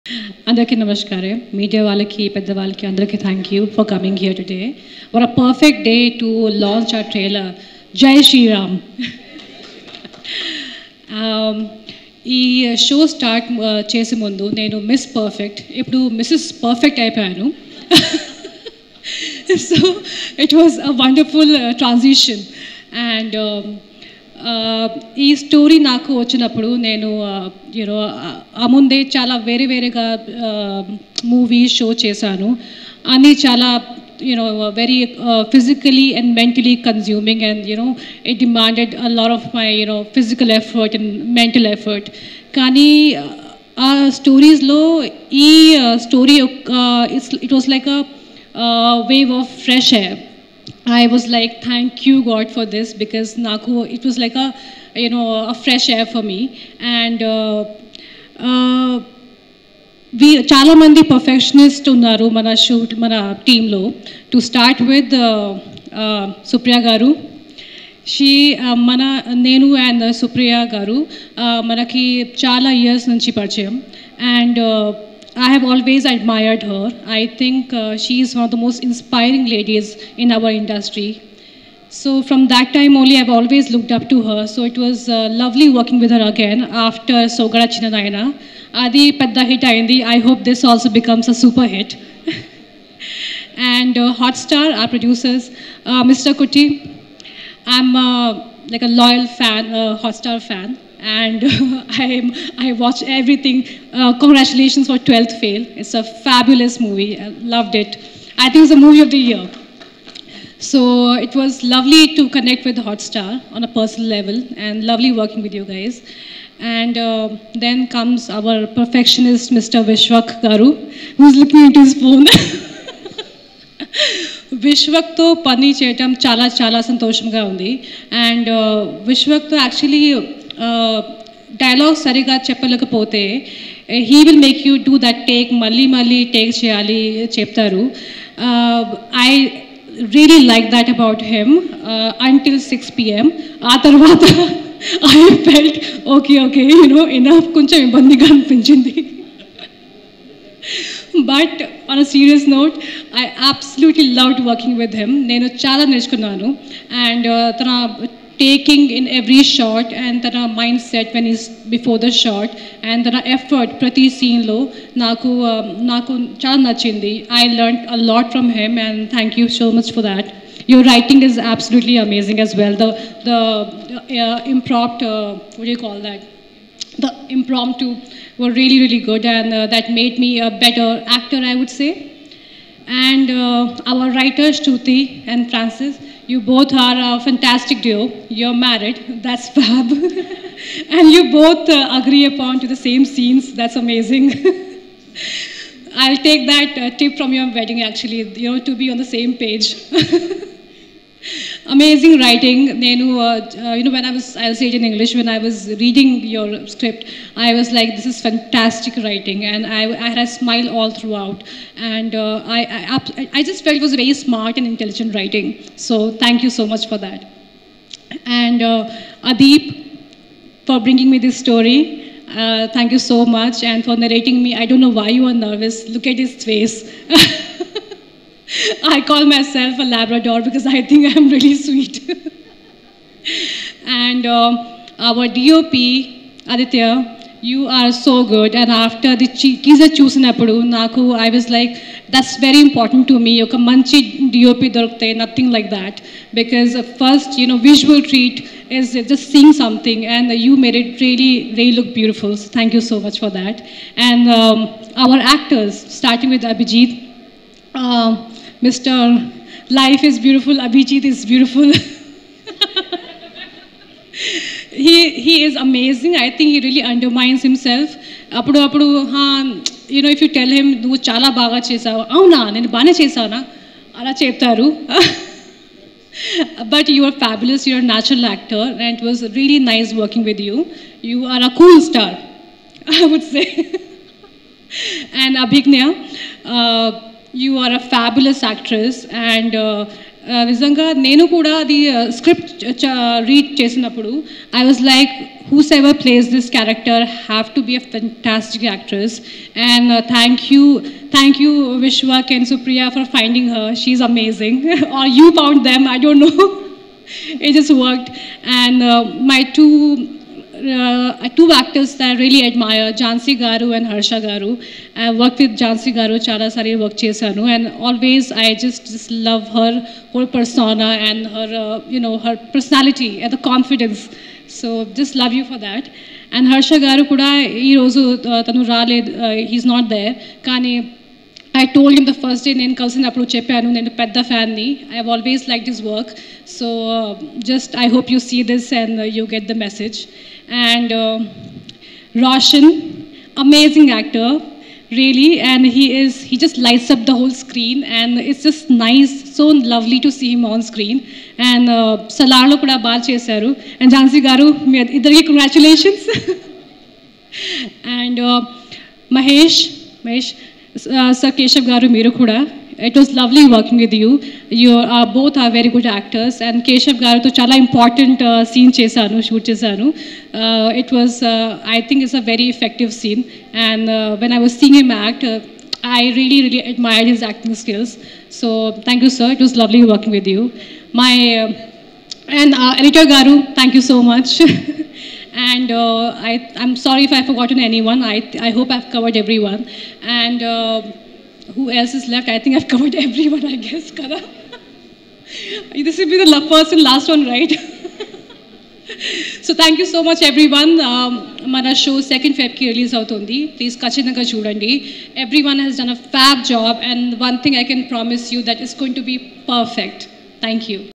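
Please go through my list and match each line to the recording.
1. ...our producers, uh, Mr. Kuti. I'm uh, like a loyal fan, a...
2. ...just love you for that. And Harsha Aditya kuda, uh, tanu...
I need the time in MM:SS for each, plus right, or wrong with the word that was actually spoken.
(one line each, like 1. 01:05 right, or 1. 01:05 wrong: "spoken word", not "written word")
1. 01:34 right
2. 05:24 wrong: "Garu", not "Aditya".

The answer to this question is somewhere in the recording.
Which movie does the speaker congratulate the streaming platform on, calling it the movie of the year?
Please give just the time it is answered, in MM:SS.
01:44.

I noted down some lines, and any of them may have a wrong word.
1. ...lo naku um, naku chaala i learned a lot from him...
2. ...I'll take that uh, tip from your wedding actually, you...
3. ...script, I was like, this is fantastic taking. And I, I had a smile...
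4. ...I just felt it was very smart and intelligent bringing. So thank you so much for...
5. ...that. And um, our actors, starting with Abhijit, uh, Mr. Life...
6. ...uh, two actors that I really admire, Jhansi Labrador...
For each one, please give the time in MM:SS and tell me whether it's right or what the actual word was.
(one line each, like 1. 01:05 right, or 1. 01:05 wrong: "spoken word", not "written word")
1. 02:44 right
2. 03:15 right
3. 03:26 wrong: "writing", not "taking"
4. 03:33 wrong: "writing", not "bringing"
5. 04:13 right
6. 05:10 wrong: "Garu", not "Labrador".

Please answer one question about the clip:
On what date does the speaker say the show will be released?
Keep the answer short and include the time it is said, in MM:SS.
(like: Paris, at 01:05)
2nd February, at 06:42.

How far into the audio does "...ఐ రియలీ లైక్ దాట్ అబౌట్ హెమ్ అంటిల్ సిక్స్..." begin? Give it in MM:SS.
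02:19.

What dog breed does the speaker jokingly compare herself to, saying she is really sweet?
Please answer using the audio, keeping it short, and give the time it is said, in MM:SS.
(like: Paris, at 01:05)
Labrador, at 03:49.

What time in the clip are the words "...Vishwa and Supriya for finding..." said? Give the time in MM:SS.
05:01.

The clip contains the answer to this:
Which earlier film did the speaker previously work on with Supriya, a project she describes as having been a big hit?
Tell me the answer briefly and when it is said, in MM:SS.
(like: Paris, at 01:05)
Soggade Chinni Nayana, at 01:27.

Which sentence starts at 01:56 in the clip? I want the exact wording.
And uh, then comes our perfectionist, Mr.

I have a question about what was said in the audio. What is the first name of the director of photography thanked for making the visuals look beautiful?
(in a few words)
Aditya.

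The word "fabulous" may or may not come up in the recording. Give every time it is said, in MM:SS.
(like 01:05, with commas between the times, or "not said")
01:46, 04:37, 04:47.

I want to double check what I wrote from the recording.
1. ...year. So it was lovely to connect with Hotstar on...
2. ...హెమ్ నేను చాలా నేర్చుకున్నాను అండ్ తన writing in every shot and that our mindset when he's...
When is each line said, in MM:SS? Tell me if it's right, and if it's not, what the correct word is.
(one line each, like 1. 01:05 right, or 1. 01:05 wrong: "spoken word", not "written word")
1. 01:49 right
2. 02:35 wrong: "taking", not "writing".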